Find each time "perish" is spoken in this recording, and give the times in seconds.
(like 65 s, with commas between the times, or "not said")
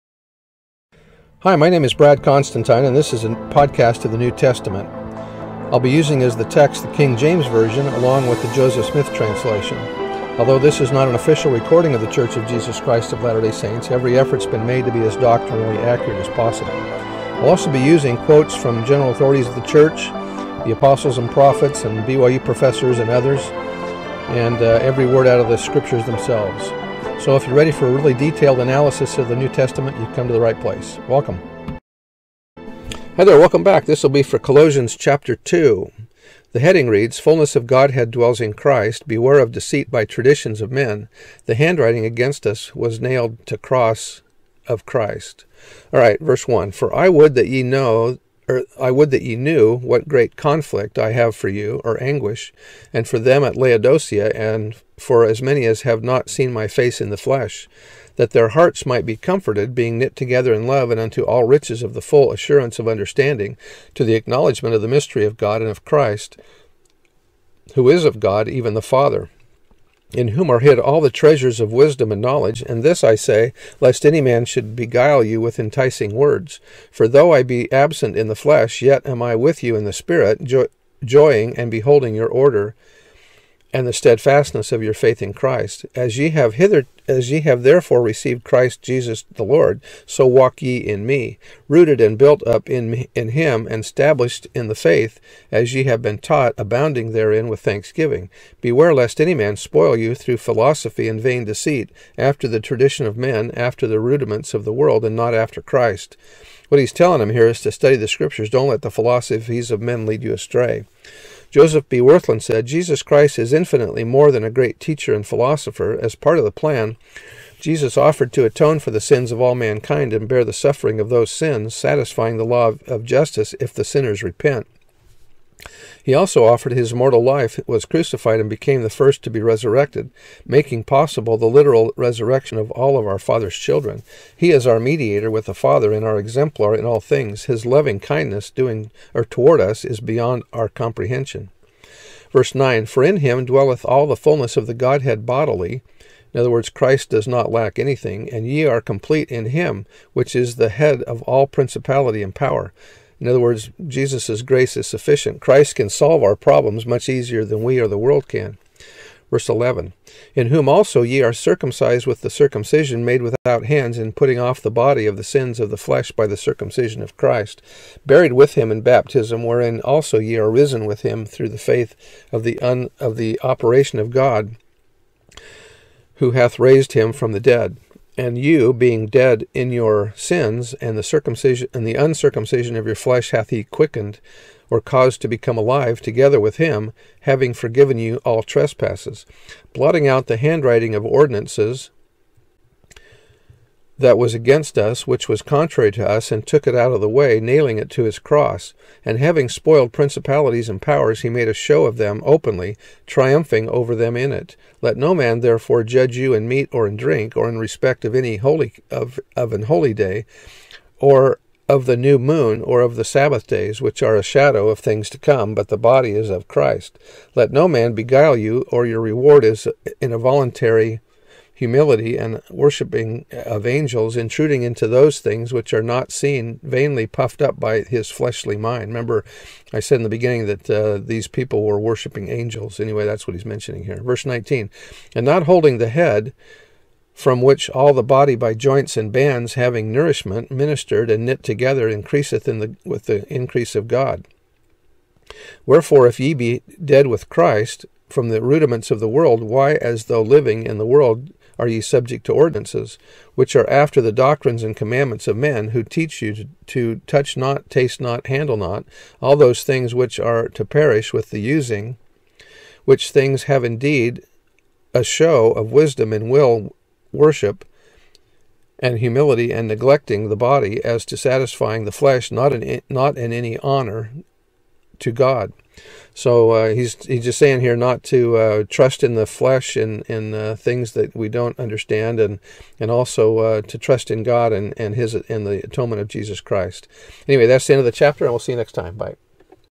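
260 s.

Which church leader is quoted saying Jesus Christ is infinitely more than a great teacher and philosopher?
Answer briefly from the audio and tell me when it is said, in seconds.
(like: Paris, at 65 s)
Joseph B. Wirthlin, at 111 s.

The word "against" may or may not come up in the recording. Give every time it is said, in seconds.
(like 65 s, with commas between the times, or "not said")
42 s, 194 s.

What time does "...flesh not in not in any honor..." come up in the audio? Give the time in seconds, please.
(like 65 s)
271 s.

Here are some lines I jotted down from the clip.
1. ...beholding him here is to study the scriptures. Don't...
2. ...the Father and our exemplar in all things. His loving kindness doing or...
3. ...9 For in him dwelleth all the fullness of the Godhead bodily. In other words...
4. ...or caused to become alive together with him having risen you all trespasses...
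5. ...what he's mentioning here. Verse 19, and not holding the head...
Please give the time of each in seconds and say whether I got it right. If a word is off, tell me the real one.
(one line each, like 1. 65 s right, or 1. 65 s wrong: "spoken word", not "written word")
1. 106 s wrong: "telling", not "beholding"
2. 135 s right
3. 142 s right
4. 184 s wrong: "forgiven", not "risen"
5. 233 s right.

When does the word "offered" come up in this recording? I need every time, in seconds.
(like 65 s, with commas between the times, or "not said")
117 s, 126 s.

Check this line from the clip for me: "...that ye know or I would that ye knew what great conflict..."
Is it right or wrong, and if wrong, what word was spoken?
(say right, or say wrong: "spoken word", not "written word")
right.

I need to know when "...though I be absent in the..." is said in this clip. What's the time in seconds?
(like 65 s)
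77 s.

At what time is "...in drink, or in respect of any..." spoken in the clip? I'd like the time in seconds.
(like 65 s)
206 s.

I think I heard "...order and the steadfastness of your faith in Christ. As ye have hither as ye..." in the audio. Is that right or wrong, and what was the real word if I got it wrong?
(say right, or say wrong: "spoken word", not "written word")
right.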